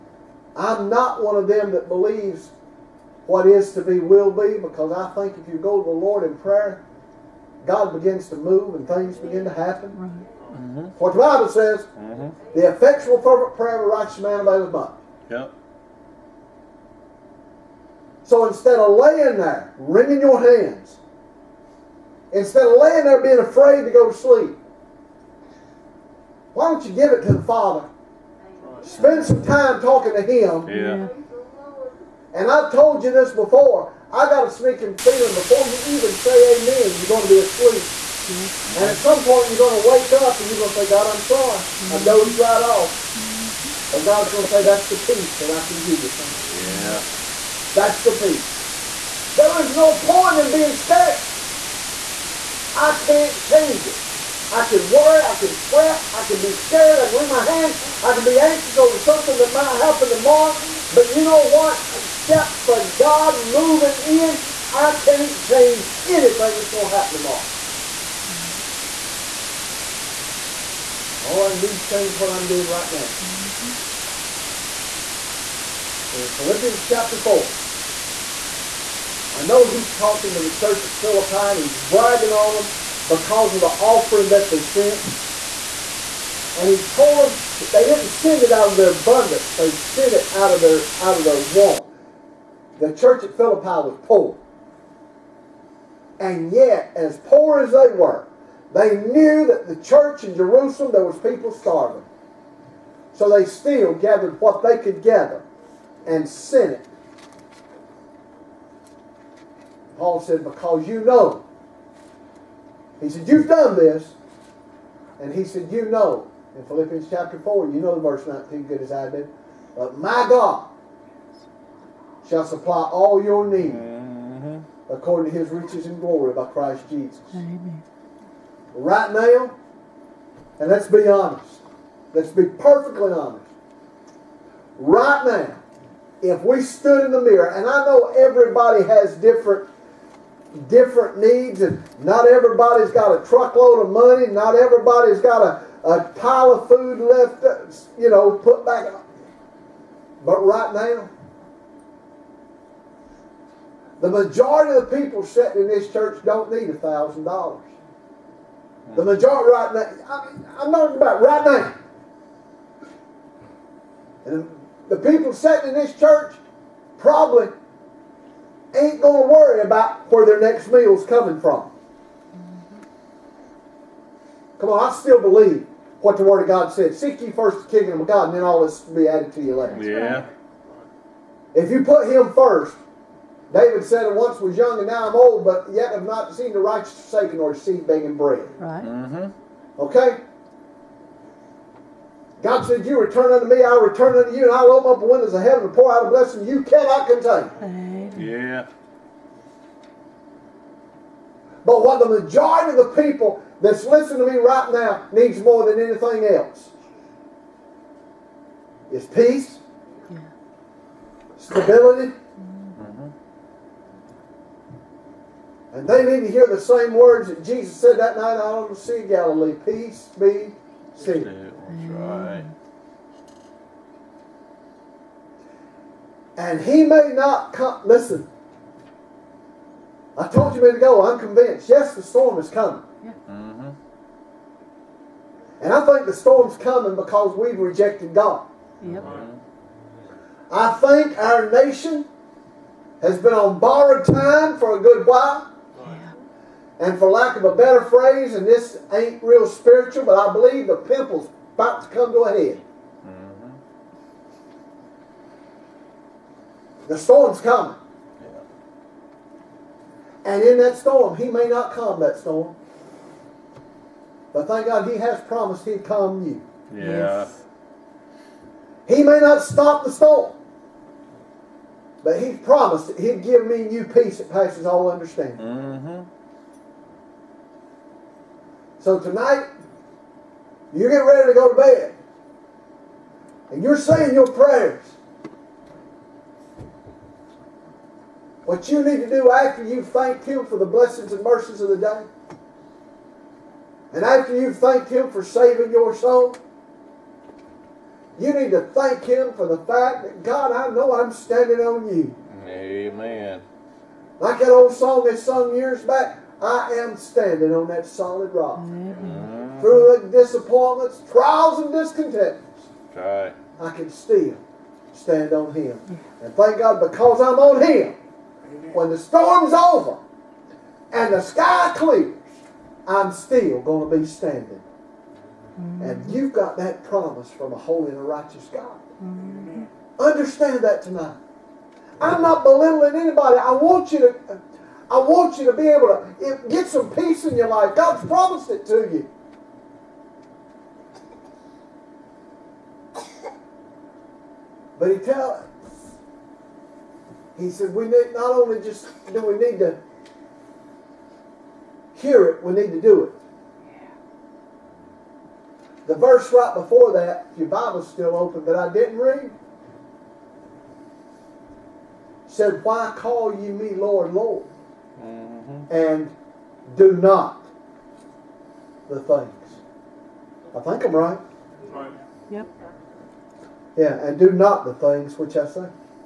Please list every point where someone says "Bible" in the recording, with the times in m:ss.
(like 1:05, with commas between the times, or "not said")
0:11, 5:57.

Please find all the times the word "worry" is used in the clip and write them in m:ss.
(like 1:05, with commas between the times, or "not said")
0:54, 2:49.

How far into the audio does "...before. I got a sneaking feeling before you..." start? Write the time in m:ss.
0:33.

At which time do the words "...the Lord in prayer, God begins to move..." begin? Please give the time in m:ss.
0:05.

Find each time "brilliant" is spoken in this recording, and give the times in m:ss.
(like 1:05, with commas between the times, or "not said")
not said.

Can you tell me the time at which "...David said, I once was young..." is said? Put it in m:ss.
3:03.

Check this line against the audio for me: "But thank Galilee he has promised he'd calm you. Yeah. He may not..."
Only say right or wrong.
wrong.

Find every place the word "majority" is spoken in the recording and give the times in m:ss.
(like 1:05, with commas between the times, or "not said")
2:34, 2:39, 3:22.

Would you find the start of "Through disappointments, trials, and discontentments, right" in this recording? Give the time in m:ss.
5:09.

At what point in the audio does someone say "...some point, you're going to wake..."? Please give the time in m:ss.
0:38.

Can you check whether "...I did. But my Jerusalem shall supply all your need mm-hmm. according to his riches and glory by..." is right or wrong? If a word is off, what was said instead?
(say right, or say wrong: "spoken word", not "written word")
wrong: "God", not "Jerusalem".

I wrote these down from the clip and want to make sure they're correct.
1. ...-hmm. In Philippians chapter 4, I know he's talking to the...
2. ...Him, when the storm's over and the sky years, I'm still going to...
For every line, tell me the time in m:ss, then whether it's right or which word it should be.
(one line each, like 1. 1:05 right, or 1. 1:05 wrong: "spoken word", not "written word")
1. 1:13 right
2. 5:17 wrong: "clears", not "years".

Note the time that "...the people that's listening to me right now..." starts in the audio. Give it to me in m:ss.
3:22.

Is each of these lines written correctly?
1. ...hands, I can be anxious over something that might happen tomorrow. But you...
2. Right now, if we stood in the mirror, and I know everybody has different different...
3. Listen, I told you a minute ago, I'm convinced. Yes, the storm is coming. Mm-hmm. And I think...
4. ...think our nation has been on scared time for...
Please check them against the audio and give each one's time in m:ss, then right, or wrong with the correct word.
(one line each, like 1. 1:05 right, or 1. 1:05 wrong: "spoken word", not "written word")
1. 0:57 right
2. 2:14 right
3. 3:47 right
4. 4:00 wrong: "borrowed", not "scared".